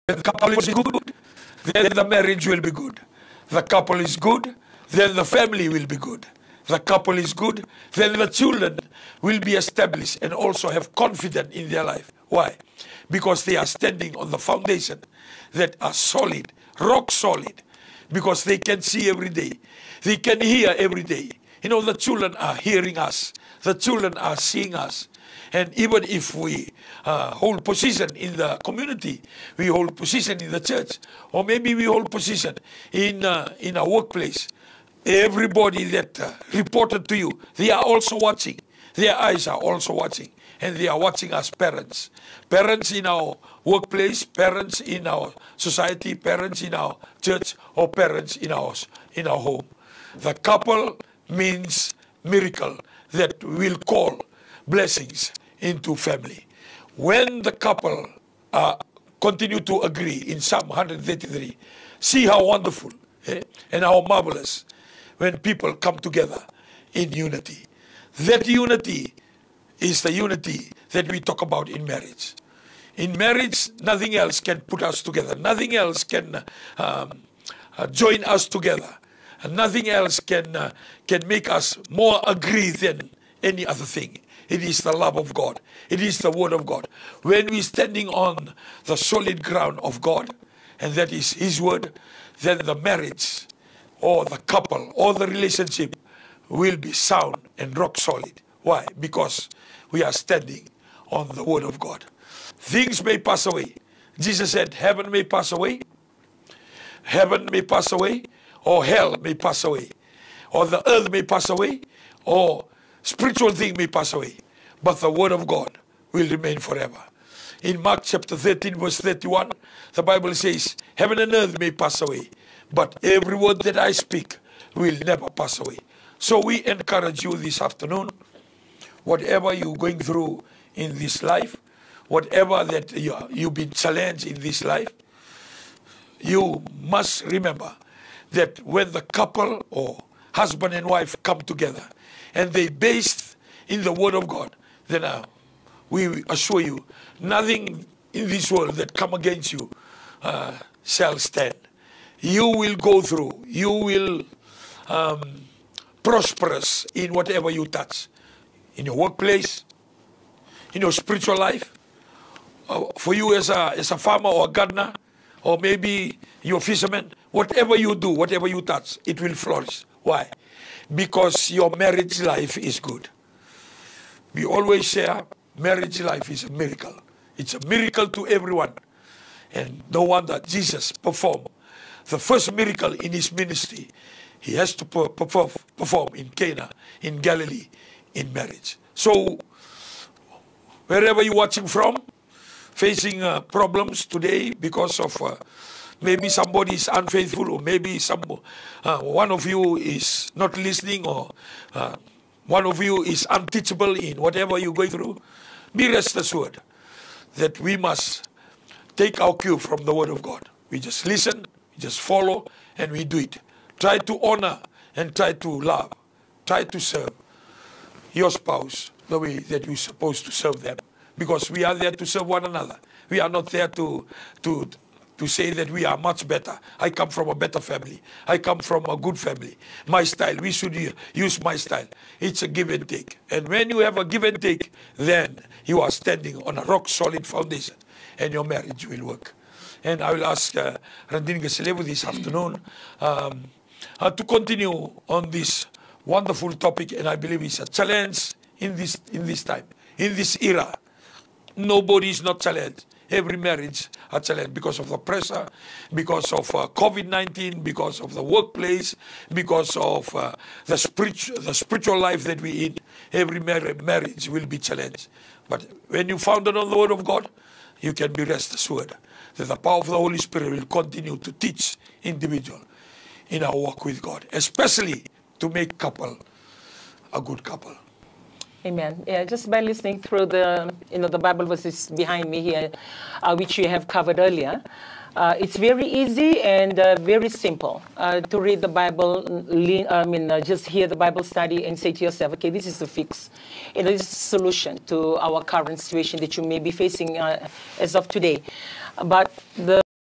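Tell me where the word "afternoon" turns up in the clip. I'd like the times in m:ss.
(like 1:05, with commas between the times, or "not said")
2:07, 4:02.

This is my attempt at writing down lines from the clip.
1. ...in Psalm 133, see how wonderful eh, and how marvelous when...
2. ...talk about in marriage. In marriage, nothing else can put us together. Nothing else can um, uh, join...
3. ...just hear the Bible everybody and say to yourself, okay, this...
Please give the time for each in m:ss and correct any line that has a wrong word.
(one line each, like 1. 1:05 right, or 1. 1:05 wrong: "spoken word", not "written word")
1. 1:00 right
2. 1:11 right
3. 4:50 wrong: "study", not "everybody".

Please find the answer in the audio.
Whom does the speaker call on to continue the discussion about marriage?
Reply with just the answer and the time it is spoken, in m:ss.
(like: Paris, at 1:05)
Randini Gaselevu, at 4:01.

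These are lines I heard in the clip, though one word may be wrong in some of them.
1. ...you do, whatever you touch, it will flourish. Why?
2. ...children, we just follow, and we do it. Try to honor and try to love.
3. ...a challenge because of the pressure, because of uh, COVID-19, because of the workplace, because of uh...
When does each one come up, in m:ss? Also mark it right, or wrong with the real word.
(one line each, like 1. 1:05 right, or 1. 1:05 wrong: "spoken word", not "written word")
1. 2:47 right
2. 3:31 wrong: "listen", not "children"
3. 4:14 right.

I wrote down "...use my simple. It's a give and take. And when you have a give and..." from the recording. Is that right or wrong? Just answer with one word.
wrong.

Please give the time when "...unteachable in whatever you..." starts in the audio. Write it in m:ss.
3:23.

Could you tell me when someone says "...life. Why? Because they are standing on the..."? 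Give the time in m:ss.
0:11.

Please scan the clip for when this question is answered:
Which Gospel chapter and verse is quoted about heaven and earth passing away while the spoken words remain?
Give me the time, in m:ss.
1:57.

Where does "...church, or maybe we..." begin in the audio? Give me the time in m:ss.
0:30.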